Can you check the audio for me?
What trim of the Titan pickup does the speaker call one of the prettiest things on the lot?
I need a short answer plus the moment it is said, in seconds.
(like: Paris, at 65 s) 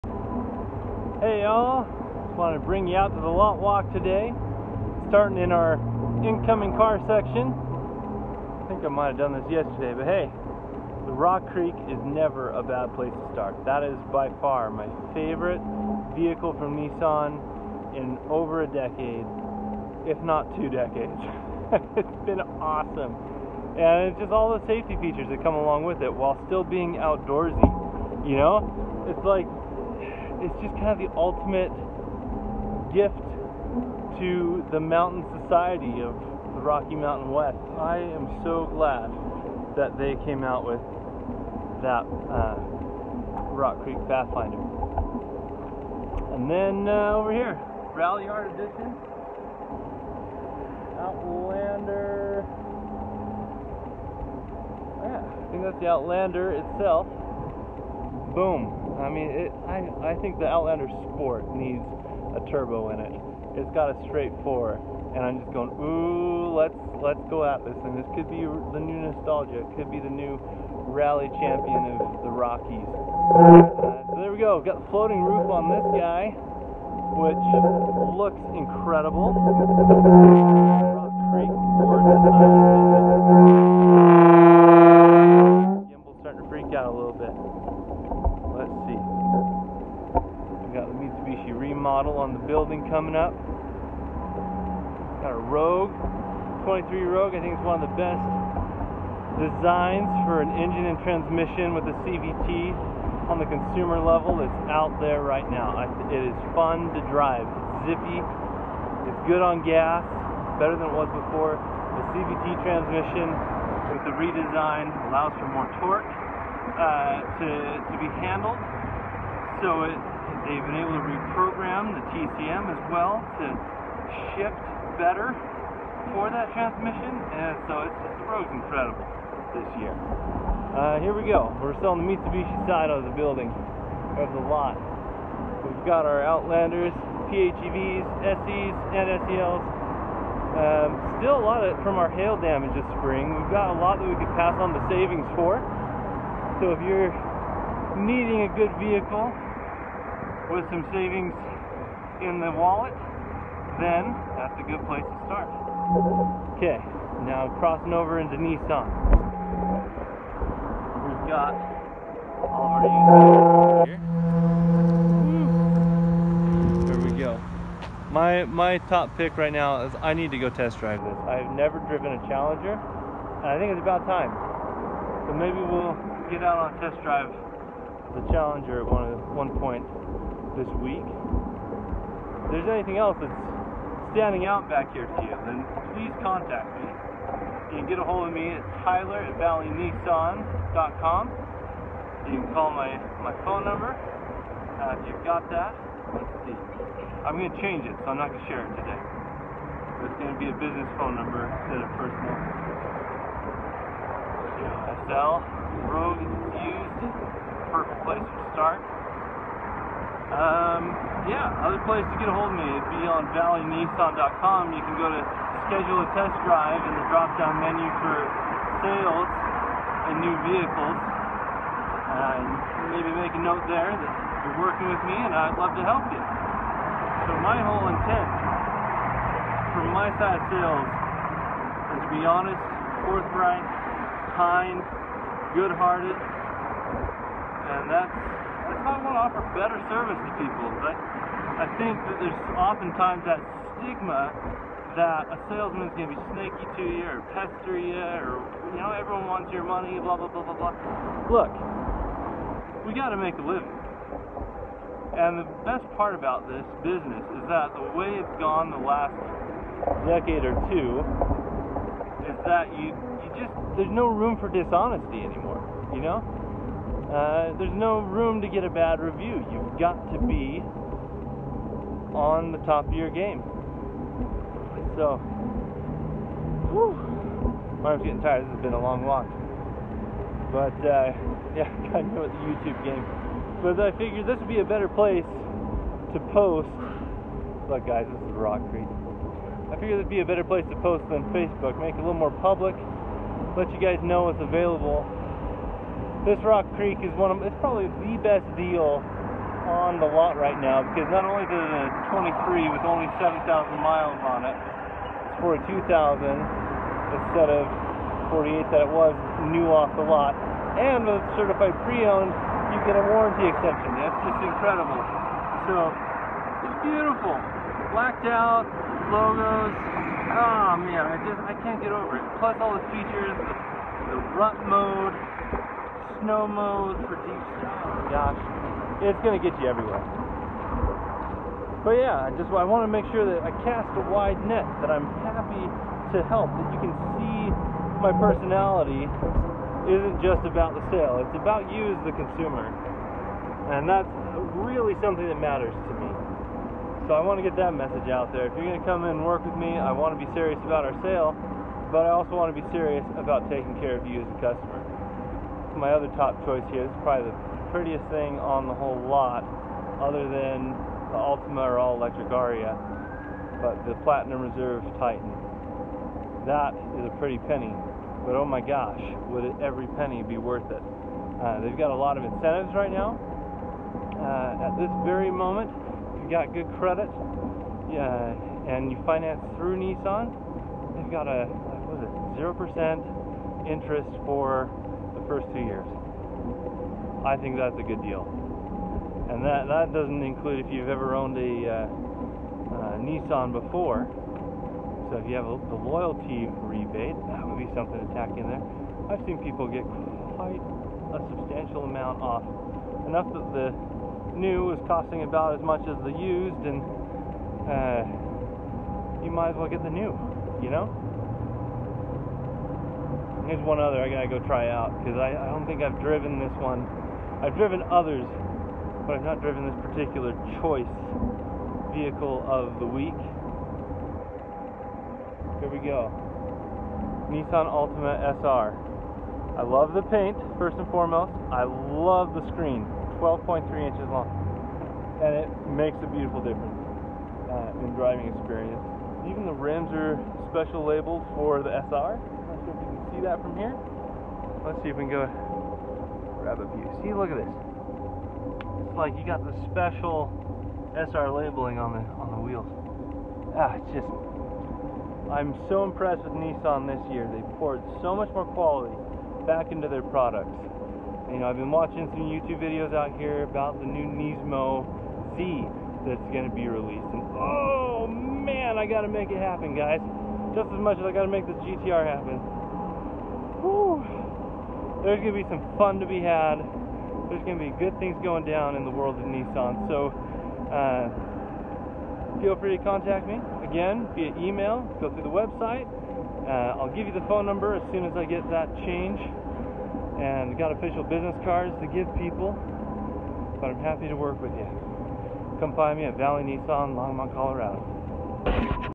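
Platinum Reserve, at 364 s.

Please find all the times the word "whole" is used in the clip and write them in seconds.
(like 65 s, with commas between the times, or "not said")
227 s, 358 s.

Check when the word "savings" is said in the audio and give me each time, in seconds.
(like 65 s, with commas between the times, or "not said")
144 s, 150 s.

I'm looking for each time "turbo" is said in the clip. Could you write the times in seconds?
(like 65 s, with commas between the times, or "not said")
62 s.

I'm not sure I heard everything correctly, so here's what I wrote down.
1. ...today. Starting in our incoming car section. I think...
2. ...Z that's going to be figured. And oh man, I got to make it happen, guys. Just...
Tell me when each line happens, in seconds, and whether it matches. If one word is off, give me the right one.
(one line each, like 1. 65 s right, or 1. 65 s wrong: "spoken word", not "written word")
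1. 3 s right
2. 465 s wrong: "released", not "figured".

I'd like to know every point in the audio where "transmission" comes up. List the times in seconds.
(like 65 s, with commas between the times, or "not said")
101 s, 112 s, 126 s.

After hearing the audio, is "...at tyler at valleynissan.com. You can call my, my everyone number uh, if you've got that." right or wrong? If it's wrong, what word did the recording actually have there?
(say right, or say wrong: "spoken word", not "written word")
wrong: "phone", not "everyone".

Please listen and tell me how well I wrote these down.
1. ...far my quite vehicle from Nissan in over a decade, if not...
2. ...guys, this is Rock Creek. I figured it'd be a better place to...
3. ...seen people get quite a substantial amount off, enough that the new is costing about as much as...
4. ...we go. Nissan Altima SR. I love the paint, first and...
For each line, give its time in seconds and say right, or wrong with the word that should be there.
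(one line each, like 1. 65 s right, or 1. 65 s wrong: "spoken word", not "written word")
1. 14 s wrong: "favorite", not "quite"
2. 287 s right
3. 399 s right
4. 425 s right.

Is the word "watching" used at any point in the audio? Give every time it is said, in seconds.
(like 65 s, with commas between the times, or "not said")
461 s.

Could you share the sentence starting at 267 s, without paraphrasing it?
Uh, there's no room to get a bad review.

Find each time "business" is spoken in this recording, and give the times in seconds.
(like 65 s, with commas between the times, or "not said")
200 s, 256 s, 491 s.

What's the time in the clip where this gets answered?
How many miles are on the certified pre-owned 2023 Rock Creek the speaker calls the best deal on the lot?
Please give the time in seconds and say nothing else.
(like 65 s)
303 s.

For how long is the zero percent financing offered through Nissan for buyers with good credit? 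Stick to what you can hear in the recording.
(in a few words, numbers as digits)
2 years.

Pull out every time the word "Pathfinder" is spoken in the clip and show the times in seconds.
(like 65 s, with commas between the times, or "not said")
44 s.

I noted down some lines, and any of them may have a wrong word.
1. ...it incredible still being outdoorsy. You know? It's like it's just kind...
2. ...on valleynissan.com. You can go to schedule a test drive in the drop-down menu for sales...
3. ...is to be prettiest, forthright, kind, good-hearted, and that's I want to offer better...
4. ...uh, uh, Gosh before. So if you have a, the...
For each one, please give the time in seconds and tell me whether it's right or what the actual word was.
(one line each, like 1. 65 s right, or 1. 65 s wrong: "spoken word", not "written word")
1. 26 s wrong: "while", not "incredible"
2. 213 s right
3. 230 s wrong: "honest", not "prettiest"
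4. 391 s wrong: "Nissan", not "Gosh".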